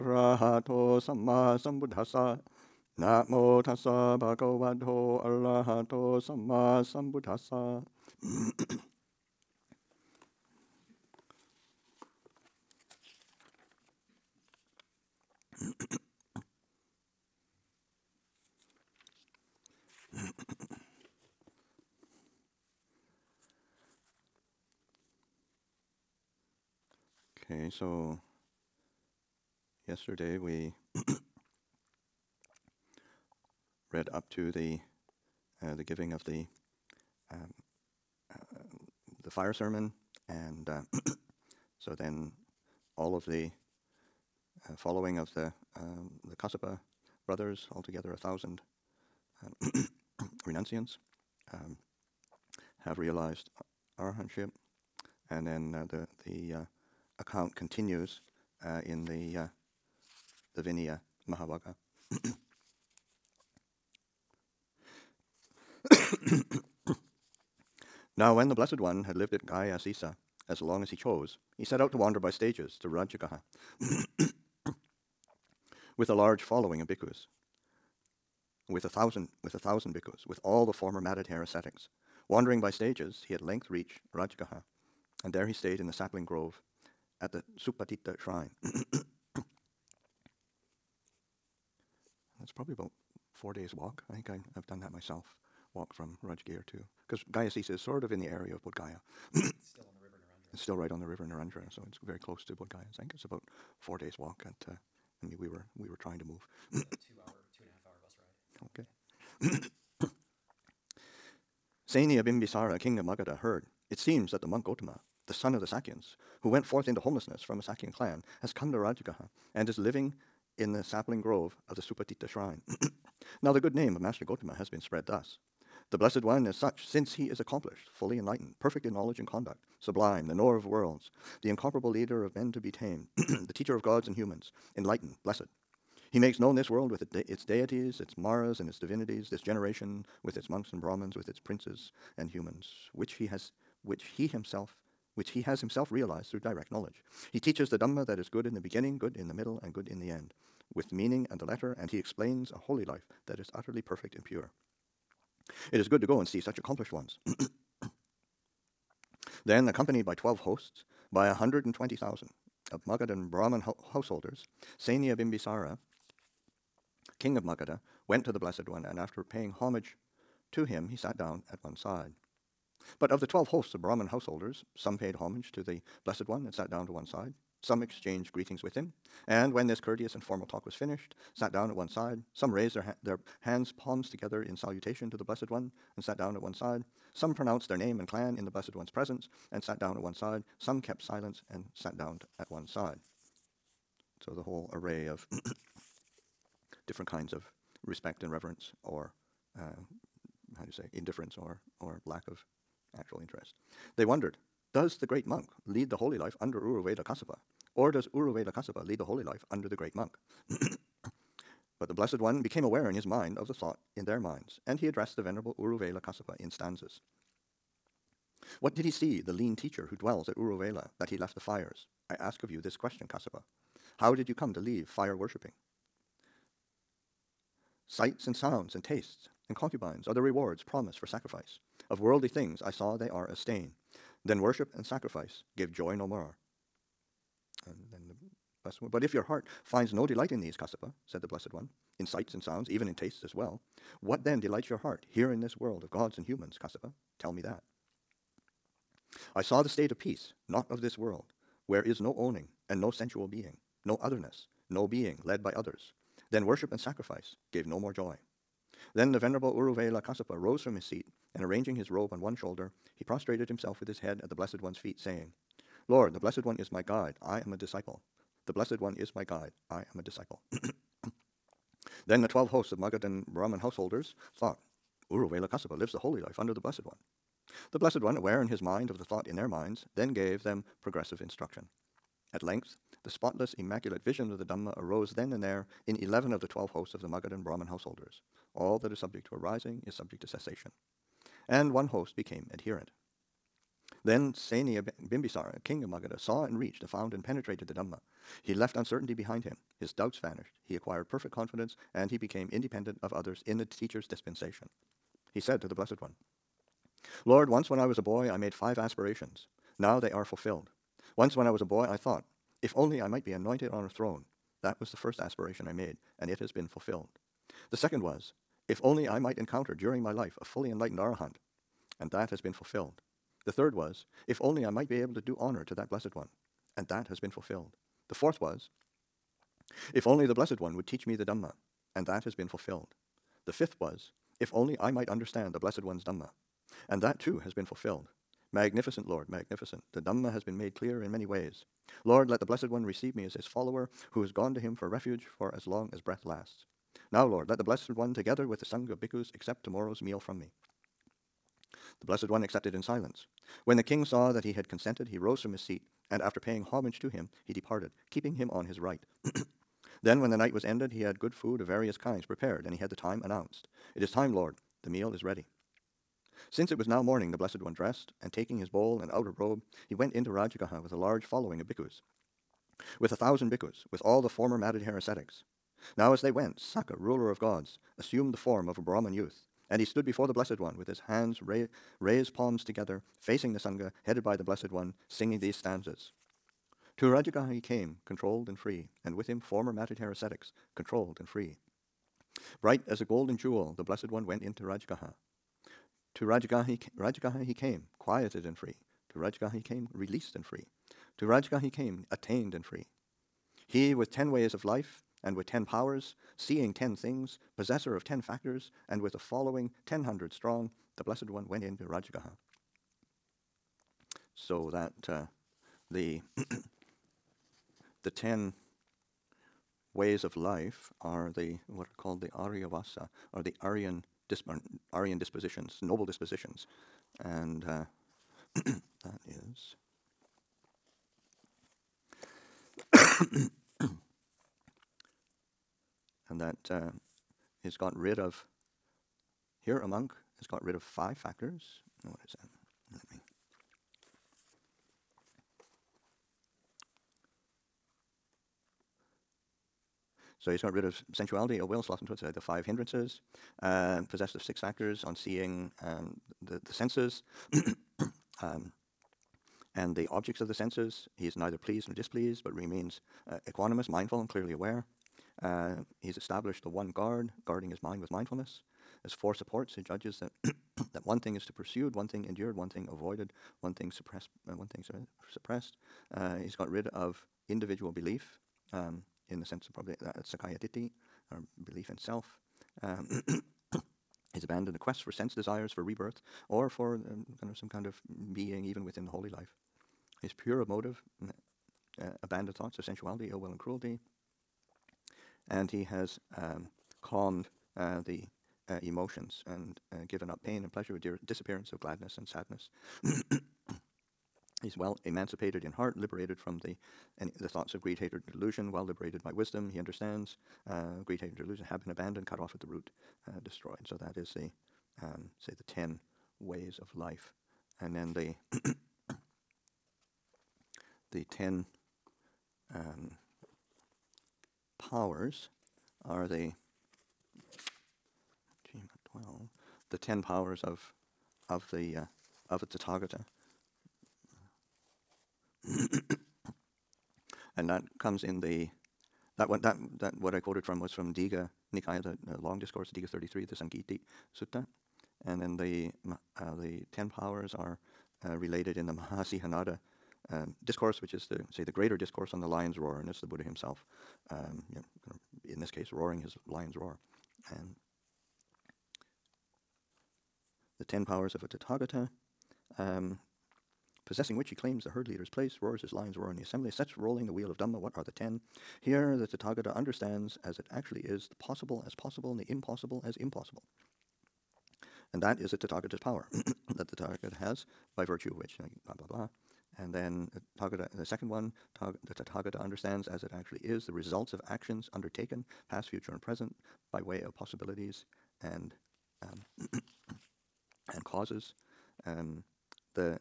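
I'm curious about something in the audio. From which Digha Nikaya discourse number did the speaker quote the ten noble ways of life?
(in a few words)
Digha 33.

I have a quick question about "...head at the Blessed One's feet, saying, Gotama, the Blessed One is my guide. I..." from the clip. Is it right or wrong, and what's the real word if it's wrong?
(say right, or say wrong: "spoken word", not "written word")
wrong: "Lord", not "Gotama".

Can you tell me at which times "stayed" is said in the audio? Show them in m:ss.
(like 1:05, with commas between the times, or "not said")
1:25.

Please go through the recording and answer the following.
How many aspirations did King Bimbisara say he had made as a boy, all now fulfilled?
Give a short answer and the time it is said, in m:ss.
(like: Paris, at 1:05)
5, at 5:08.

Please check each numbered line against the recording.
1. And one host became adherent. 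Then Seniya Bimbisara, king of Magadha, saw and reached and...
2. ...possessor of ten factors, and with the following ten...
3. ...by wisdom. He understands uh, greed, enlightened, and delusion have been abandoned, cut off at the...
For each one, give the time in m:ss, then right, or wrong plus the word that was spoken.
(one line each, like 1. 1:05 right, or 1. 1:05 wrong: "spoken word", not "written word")
1. 4:51 right
2. 6:47 right
3. 8:29 wrong: "hatred", not "enlightened".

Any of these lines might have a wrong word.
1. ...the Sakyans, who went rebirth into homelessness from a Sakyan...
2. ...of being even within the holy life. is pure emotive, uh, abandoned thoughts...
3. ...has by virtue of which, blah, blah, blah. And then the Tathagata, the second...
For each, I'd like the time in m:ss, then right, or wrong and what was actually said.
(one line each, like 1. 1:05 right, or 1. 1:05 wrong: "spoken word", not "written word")
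1. 1:55 wrong: "forth", not "rebirth"
2. 8:07 right
3. 9:37 right.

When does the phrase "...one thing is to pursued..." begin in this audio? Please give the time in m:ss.
7:51.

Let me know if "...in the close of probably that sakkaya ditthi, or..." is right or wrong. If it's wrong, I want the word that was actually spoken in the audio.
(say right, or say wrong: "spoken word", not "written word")
wrong: "sense", not "close".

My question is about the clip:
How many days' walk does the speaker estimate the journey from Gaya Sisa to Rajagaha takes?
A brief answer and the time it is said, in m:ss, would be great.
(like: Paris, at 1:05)
4, at 1:33.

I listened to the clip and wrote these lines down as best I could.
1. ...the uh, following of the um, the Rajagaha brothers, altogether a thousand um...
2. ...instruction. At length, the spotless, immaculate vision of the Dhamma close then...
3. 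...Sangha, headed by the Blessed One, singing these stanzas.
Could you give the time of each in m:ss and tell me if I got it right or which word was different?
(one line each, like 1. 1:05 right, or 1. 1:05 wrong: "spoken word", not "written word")
1. 0:43 wrong: "Kassapa", not "Rajagaha"
2. 4:41 wrong: "arose", not "close"
3. 6:23 right.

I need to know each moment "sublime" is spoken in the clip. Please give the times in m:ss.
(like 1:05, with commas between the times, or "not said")
2:09.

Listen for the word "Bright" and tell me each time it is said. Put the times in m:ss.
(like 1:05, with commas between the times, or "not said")
6:32.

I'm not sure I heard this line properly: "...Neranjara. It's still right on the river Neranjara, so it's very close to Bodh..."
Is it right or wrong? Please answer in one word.
right.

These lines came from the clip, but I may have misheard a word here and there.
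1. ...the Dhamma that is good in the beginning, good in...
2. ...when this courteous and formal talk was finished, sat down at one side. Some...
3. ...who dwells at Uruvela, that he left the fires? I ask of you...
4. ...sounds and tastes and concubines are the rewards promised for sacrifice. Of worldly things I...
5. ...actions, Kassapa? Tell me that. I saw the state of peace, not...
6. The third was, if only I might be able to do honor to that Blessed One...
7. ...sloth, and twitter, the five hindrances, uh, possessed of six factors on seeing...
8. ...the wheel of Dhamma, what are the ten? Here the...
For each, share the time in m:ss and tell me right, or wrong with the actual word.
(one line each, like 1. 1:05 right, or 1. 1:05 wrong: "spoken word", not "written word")
1. 2:27 right
2. 2:59 right
3. 3:39 right
4. 3:48 right
5. 4:06 wrong: "humans", not "actions"
6. 5:23 right
7. 7:31 right
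8. 9:27 right.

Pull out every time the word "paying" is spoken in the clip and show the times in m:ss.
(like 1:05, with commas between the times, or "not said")
2:49, 5:56.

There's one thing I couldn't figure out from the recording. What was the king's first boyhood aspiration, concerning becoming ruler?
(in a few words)
Anointed on a throne.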